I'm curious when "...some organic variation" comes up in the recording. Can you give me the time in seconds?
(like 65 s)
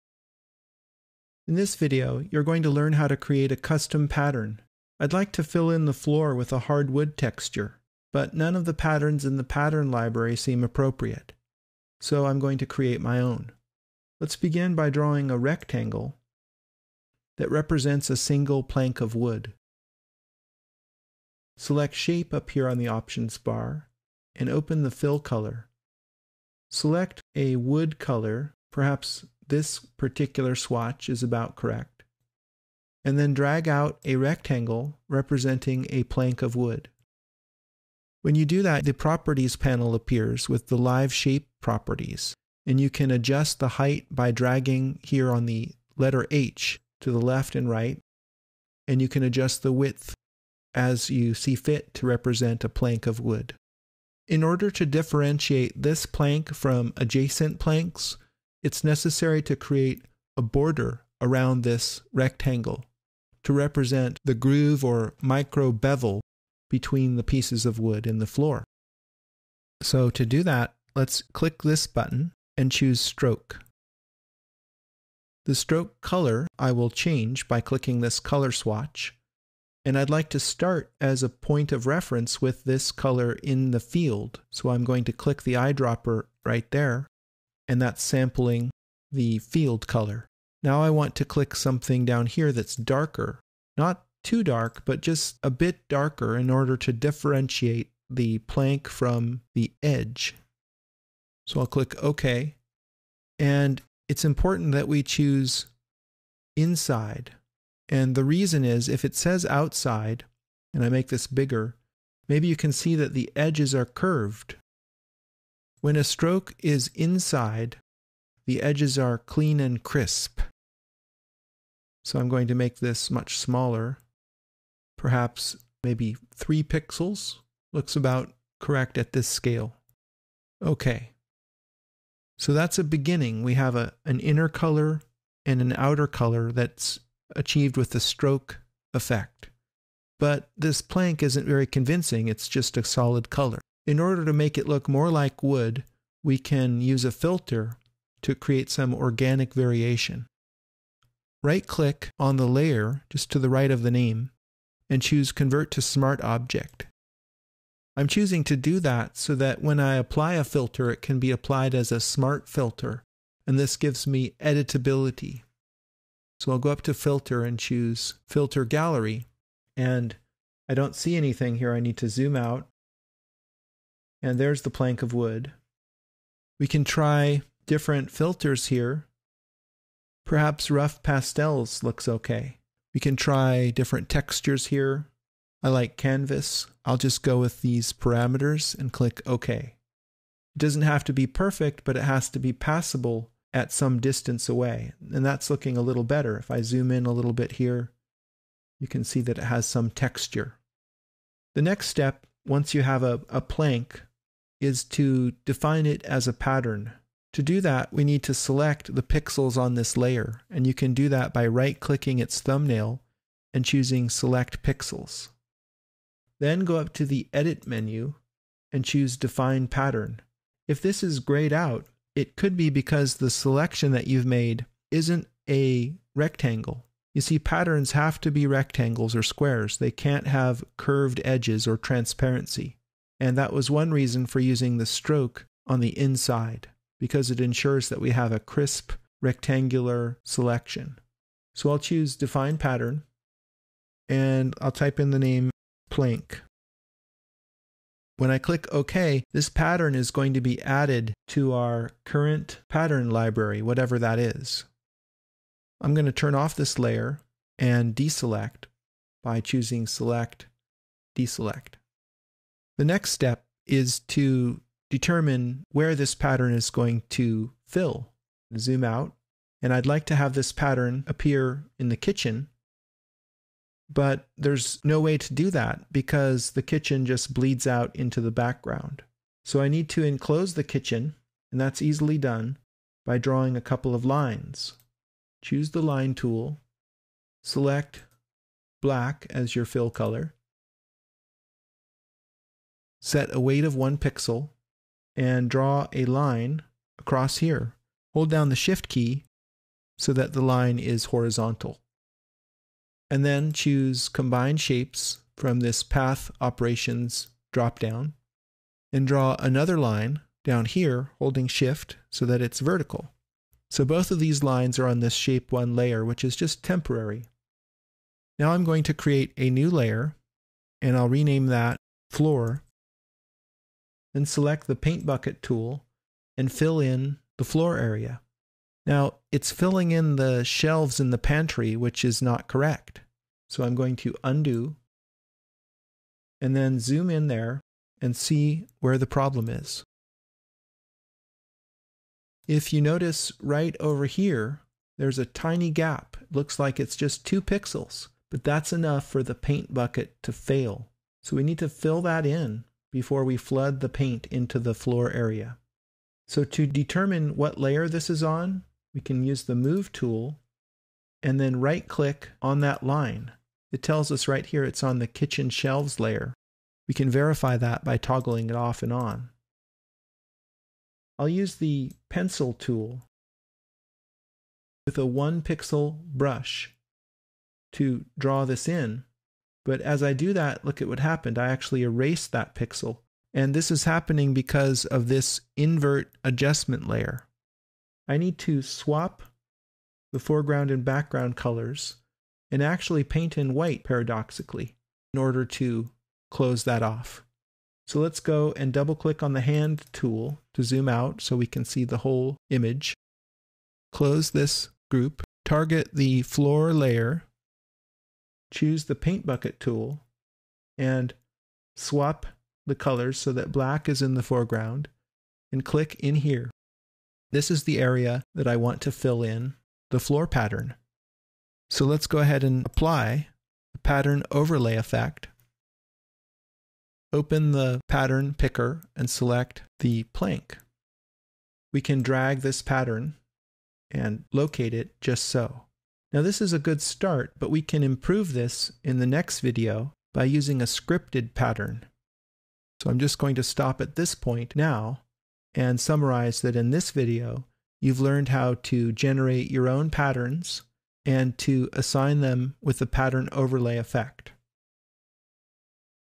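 148 s.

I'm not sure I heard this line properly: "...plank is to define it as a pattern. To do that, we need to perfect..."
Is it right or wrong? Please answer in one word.
wrong.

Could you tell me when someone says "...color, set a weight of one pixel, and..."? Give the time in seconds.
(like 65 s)
289 s.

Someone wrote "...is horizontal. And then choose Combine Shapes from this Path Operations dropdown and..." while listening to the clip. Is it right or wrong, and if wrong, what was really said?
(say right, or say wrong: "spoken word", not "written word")
right.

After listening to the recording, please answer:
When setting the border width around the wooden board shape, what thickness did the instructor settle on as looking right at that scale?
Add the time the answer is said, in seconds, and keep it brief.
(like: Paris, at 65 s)
3 pixels, at 126 s.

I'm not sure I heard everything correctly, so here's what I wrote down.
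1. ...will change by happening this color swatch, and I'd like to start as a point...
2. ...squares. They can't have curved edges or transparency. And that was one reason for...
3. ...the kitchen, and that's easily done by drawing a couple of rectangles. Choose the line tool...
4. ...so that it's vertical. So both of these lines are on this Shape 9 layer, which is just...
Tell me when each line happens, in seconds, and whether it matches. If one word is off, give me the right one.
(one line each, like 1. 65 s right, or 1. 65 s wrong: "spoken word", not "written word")
1. 76 s wrong: "clicking", not "happening"
2. 229 s right
3. 280 s wrong: "lines", not "rectangles"
4. 312 s wrong: "1", not "9".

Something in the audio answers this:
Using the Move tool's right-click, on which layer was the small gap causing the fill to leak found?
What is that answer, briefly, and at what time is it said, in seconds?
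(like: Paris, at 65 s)
Kitchen shelves, at 365 s.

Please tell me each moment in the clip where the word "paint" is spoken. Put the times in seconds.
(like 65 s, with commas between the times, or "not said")
324 s, 349 s, 353 s, 393 s, 408 s.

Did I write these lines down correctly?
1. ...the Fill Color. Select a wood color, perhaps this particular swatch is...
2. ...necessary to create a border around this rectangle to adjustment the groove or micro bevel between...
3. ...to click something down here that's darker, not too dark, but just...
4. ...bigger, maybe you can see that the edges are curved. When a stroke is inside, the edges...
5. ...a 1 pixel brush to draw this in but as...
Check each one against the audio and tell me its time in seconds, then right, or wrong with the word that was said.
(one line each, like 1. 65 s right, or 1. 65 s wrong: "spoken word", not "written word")
1. 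24 s right
2. 58 s wrong: "represent", not "adjustment"
3. 91 s right
4. 111 s right
5. 374 s right.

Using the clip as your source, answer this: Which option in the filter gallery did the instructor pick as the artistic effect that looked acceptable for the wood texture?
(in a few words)
Rough pastels.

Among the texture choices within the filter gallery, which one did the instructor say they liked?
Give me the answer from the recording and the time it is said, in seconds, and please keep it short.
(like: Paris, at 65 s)
Canvas, at 185 s.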